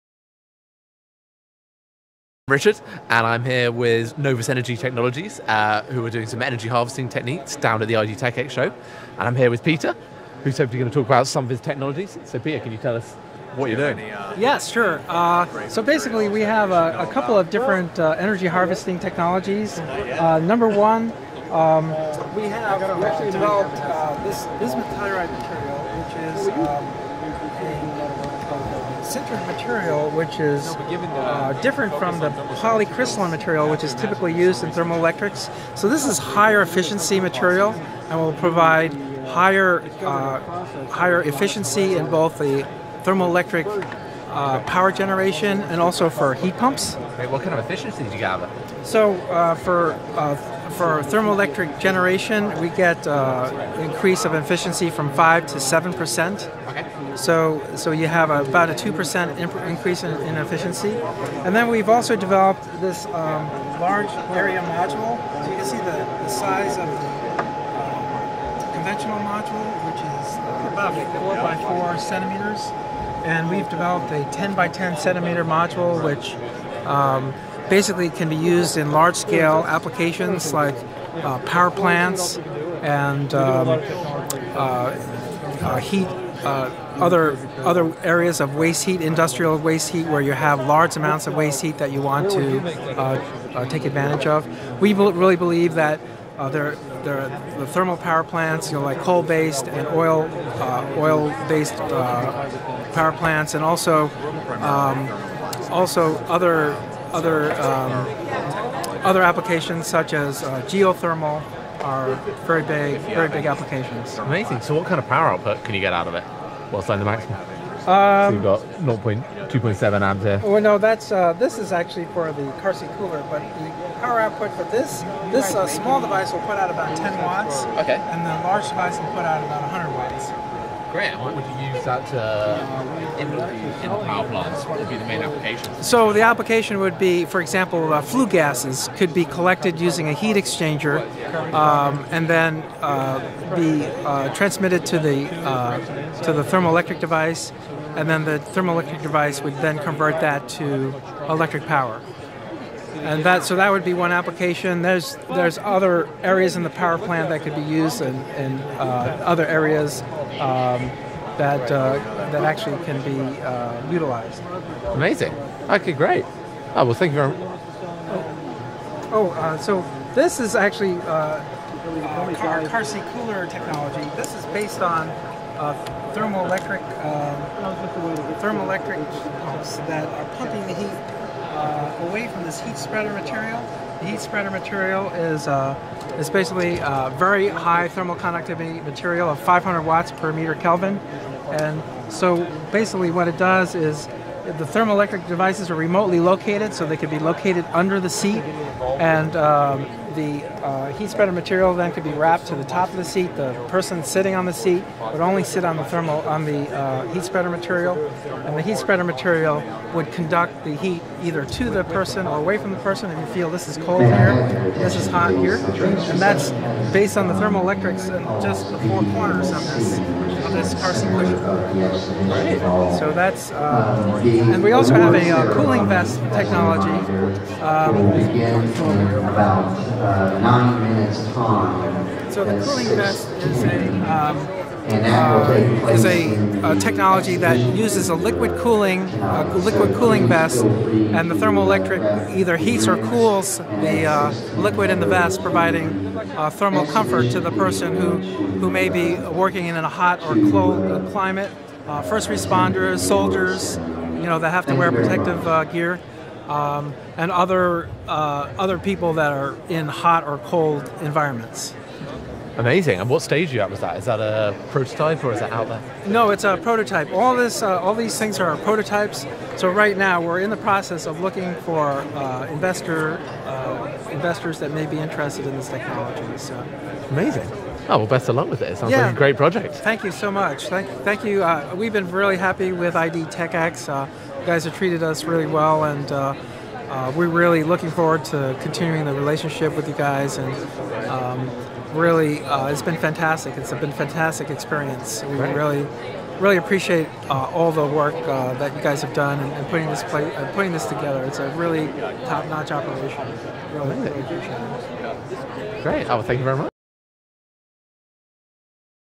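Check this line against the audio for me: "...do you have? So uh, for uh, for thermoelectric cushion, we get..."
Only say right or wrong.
wrong.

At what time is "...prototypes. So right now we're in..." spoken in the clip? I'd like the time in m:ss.
4:28.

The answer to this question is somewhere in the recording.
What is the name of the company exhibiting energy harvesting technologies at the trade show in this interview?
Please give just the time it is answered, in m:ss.
0:04.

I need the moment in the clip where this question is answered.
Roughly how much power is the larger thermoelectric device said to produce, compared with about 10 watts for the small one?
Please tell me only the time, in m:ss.
2:09.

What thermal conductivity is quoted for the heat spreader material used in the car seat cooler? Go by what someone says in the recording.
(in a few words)
500 watts per meter Kelvin.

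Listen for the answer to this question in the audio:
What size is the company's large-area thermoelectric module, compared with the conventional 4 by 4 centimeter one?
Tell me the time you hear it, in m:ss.
1:14.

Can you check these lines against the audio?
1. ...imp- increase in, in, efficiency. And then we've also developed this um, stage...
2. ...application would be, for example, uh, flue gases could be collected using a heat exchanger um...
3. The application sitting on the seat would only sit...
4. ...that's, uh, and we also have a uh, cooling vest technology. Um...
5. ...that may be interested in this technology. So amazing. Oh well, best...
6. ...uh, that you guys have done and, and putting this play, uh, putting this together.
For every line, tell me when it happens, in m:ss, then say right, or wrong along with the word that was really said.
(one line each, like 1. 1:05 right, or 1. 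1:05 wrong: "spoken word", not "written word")
1. 0:59 wrong: "large", not "stage"
2. 2:16 right
3. 3:23 wrong: "person", not "application"
4. 3:43 right
5. 4:34 right
6. 4:58 right.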